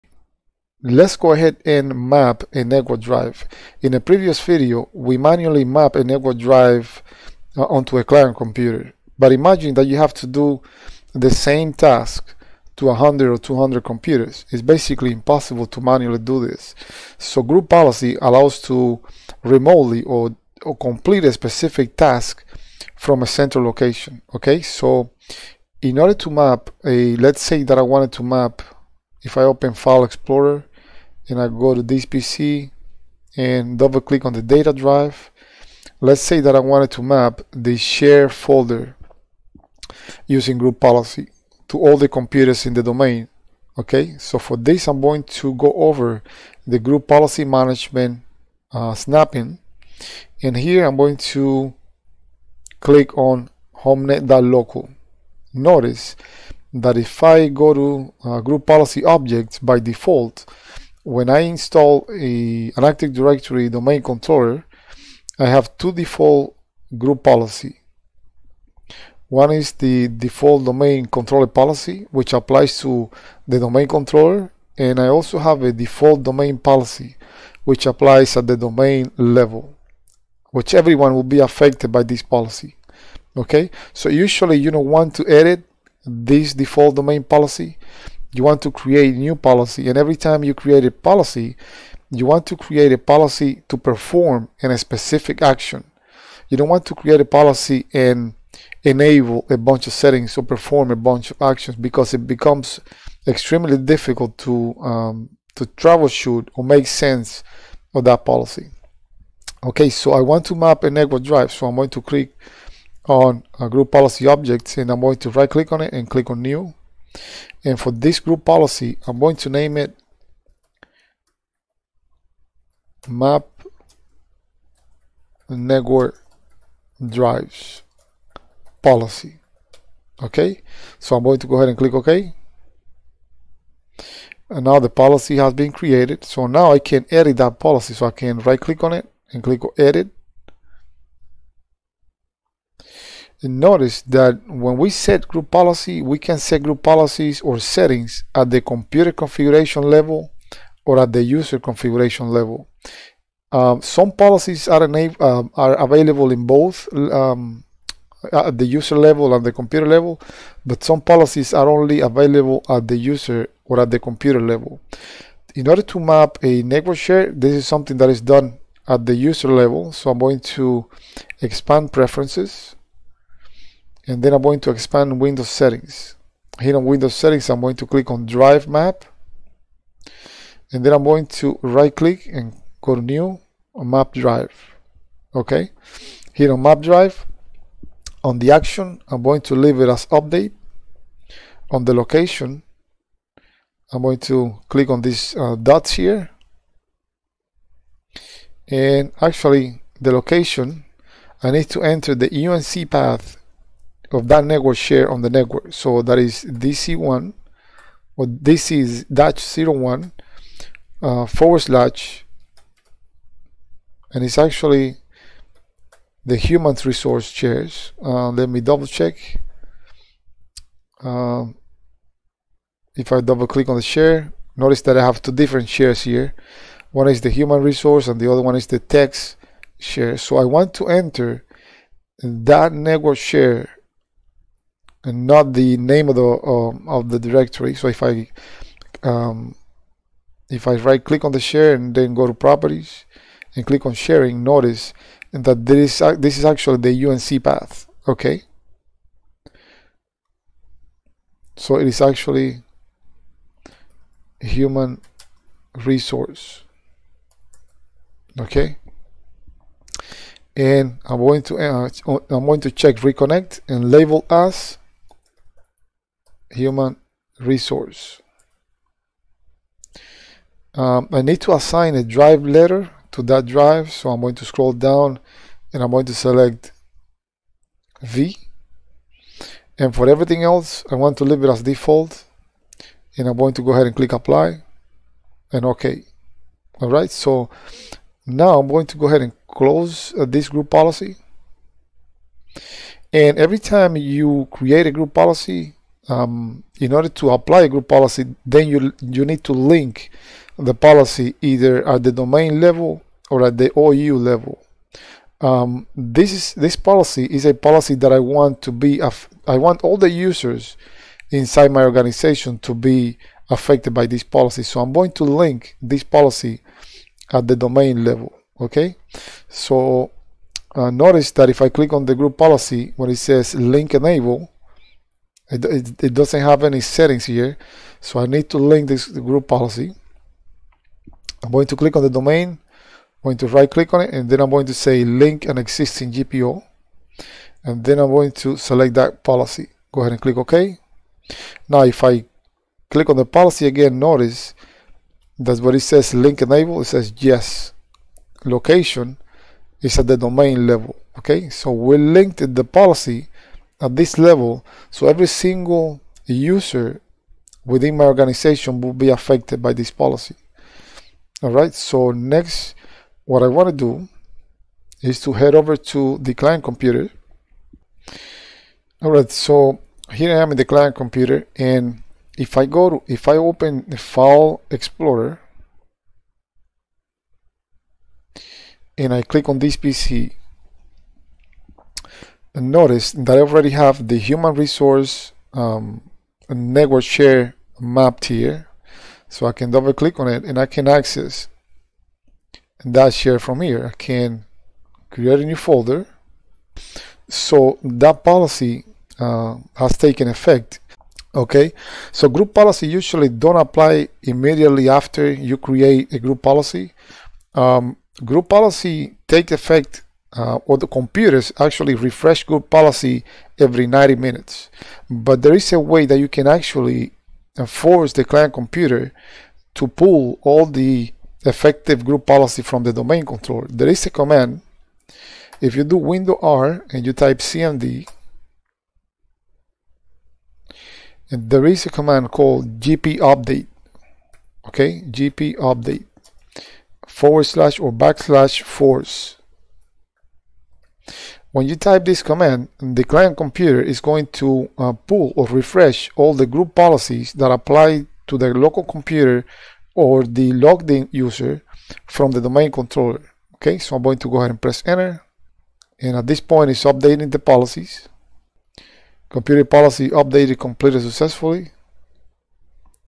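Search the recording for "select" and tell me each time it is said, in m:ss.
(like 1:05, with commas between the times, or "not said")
4:36, 5:38.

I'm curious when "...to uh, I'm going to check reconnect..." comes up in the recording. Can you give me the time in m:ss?
4:21.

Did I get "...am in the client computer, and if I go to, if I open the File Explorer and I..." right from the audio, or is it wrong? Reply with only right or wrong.
right.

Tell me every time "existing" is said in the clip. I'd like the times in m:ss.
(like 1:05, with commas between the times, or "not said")
5:35.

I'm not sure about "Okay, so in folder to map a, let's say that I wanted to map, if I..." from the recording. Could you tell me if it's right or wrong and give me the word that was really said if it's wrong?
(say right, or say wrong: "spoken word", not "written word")
wrong: "order", not "folder".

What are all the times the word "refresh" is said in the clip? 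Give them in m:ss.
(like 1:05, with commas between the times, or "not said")
6:51, 7:25.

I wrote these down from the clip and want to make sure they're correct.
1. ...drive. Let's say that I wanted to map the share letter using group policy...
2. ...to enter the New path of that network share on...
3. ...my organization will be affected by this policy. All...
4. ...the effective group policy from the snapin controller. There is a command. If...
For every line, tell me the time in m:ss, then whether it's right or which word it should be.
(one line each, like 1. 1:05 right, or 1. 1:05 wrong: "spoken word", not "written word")
1. 0:34 wrong: "folder", not "letter"
2. 3:21 wrong: "UNC", not "New"
3. 5:57 right
4. 7:00 wrong: "domain", not "snapin".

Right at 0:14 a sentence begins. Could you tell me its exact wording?
It's basically impossible to manually do this.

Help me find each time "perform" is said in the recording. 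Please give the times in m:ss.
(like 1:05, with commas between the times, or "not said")
1:33, 1:40.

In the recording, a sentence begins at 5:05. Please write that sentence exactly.
Um, this is this policy is a policy that I want to be.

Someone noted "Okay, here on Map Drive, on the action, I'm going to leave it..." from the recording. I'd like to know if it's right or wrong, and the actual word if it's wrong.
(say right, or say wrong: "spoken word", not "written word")
right.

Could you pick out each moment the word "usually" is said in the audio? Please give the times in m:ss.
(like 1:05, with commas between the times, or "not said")
1:24, 6:42.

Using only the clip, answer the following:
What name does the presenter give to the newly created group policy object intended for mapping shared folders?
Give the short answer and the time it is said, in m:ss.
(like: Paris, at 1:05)
map network drives policy, at 2:03.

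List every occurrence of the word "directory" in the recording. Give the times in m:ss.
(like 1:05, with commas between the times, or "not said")
1:03, 3:57.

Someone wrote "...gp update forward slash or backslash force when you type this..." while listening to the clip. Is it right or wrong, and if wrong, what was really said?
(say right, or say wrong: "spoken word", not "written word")
right.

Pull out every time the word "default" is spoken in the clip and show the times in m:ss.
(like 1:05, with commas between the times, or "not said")
0:59, 1:05, 1:10, 1:15, 1:26, 4:41.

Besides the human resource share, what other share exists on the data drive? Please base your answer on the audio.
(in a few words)
text share.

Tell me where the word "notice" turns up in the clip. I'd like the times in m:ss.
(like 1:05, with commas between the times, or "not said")
0:55, 2:23, 3:44, 4:04, 5:20, 5:43, 6:22.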